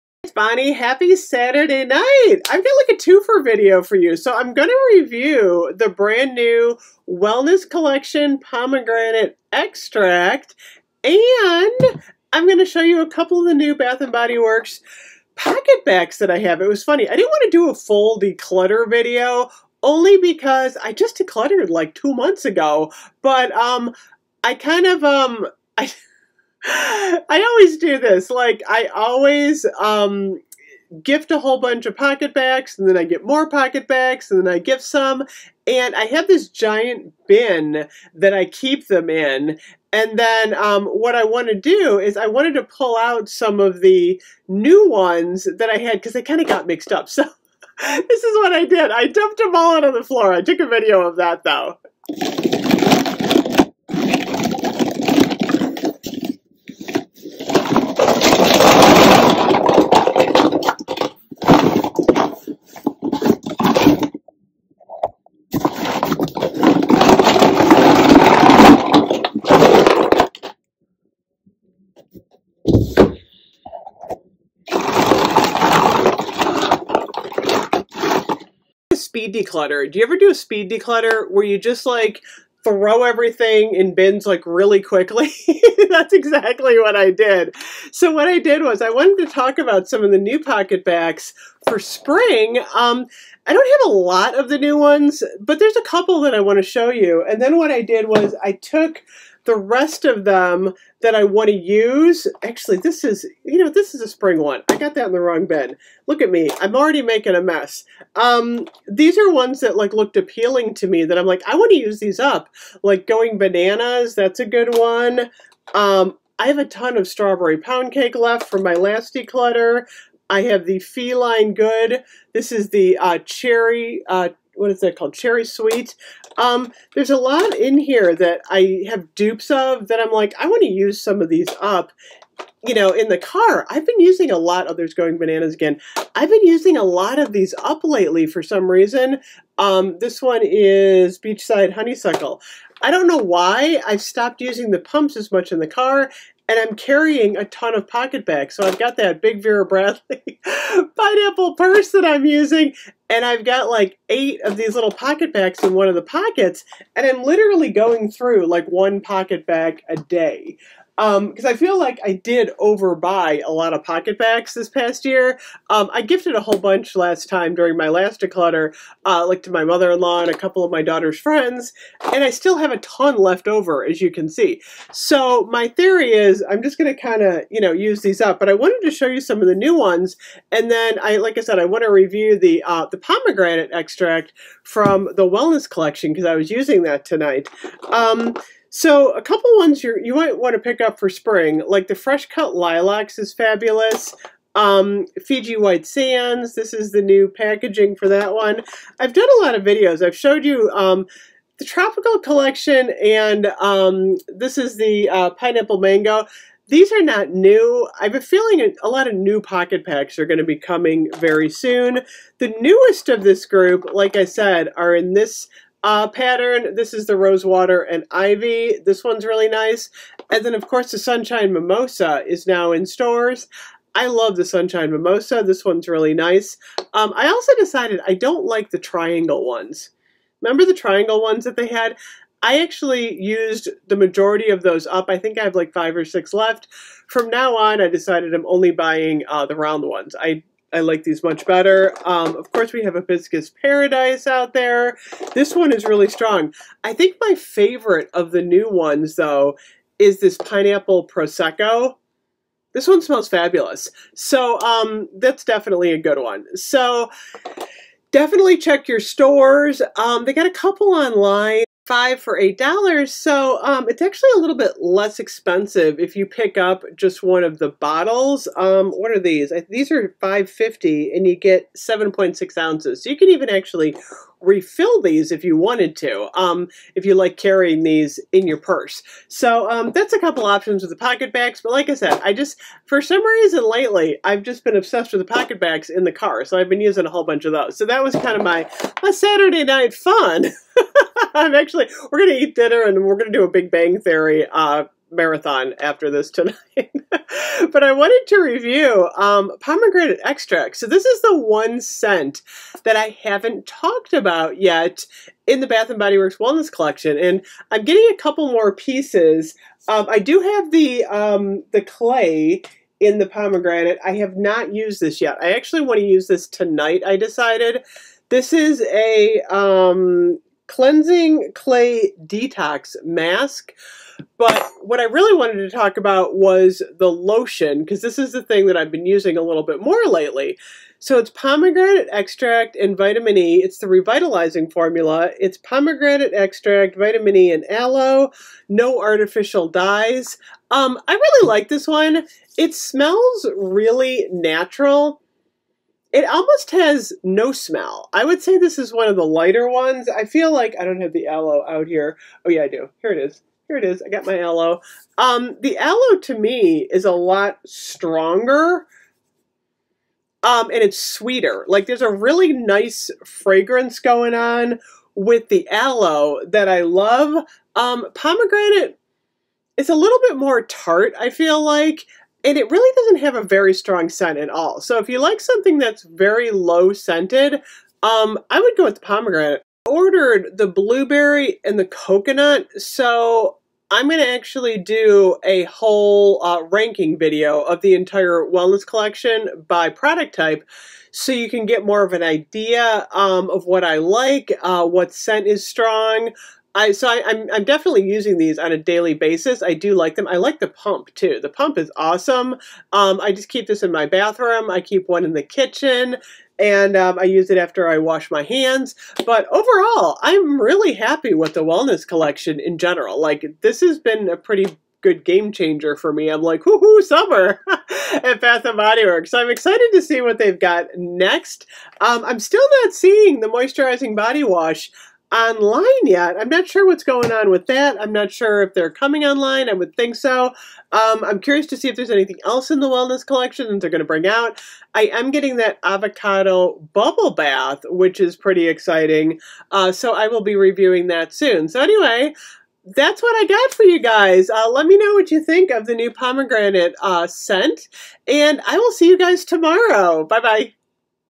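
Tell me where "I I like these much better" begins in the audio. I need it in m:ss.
4:00.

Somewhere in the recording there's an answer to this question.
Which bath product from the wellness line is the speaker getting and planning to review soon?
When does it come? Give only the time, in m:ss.
7:15.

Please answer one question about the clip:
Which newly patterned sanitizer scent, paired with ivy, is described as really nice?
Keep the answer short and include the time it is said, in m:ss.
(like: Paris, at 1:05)
Rosewater and Ivy, at 3:37.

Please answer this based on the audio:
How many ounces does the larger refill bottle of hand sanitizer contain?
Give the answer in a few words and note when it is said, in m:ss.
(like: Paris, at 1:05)
7.6 ounces, at 4:31.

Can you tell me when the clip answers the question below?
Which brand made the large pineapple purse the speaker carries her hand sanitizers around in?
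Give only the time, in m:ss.
2:29.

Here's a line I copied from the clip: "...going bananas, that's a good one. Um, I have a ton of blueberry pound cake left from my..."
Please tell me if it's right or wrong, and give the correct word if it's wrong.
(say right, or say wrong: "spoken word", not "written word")
wrong: "strawberry", not "blueberry".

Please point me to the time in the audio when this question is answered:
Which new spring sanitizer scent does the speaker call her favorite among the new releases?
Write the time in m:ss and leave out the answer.
4:10.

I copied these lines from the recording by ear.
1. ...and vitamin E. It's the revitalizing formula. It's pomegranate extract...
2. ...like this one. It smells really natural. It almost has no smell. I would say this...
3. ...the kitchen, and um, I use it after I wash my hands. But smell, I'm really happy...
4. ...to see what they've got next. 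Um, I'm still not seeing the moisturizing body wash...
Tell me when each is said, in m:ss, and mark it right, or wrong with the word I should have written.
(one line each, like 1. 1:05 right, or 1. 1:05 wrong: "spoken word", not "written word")
1. 5:32 right
2. 5:41 right
3. 6:45 wrong: "overall", not "smell"
4. 6:59 right.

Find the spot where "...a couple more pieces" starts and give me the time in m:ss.
5:08.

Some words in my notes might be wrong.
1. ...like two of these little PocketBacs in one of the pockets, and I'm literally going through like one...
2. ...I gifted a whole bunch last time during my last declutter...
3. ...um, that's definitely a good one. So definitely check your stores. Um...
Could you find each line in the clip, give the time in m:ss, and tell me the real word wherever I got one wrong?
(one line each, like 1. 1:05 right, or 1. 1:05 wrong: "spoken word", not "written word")
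1. 2:33 wrong: "eight", not "two"
2. 2:45 right
3. 4:14 right.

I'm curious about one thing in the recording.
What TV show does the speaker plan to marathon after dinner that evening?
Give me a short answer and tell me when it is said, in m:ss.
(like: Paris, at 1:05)
Big Bang Theory, at 4:53.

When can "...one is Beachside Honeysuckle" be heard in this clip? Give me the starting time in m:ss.
2:20.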